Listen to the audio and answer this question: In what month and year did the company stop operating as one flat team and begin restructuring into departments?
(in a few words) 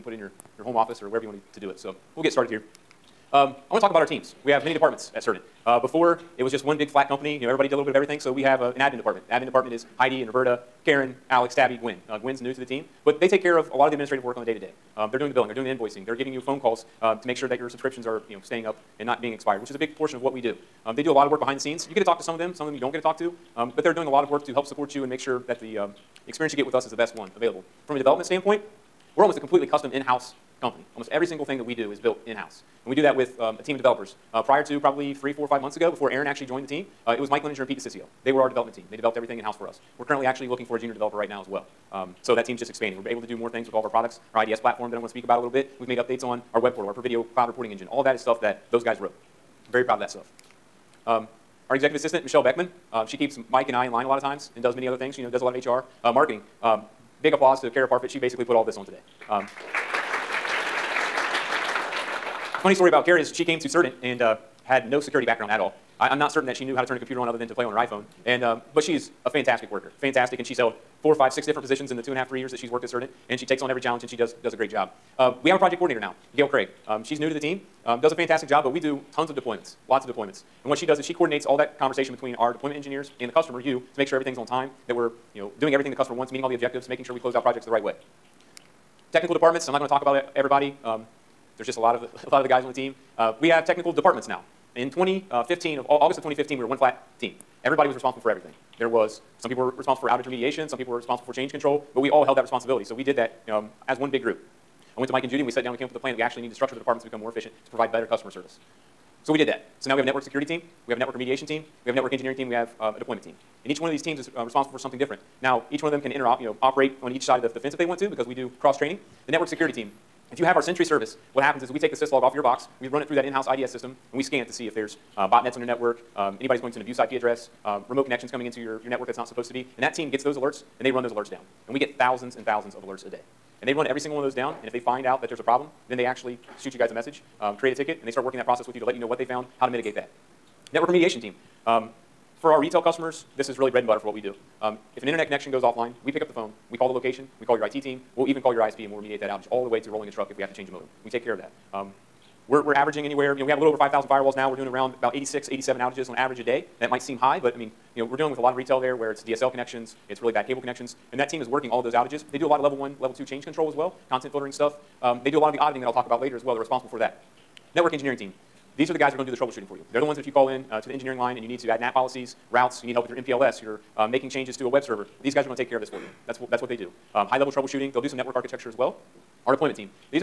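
August 2015.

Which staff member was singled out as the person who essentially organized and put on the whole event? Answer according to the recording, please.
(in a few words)
Kara Parfit.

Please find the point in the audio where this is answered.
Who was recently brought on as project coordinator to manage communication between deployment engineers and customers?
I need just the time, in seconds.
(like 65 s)
76 s.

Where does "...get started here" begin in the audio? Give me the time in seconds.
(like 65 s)
2 s.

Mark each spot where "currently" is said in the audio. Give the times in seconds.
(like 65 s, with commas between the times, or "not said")
40 s.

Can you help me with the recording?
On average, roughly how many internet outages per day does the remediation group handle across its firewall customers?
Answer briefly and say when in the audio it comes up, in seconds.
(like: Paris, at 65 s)
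86 to 87, at 155 s.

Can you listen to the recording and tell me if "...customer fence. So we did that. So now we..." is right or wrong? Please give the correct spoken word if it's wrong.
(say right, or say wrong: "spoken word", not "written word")
wrong: "service", not "fence".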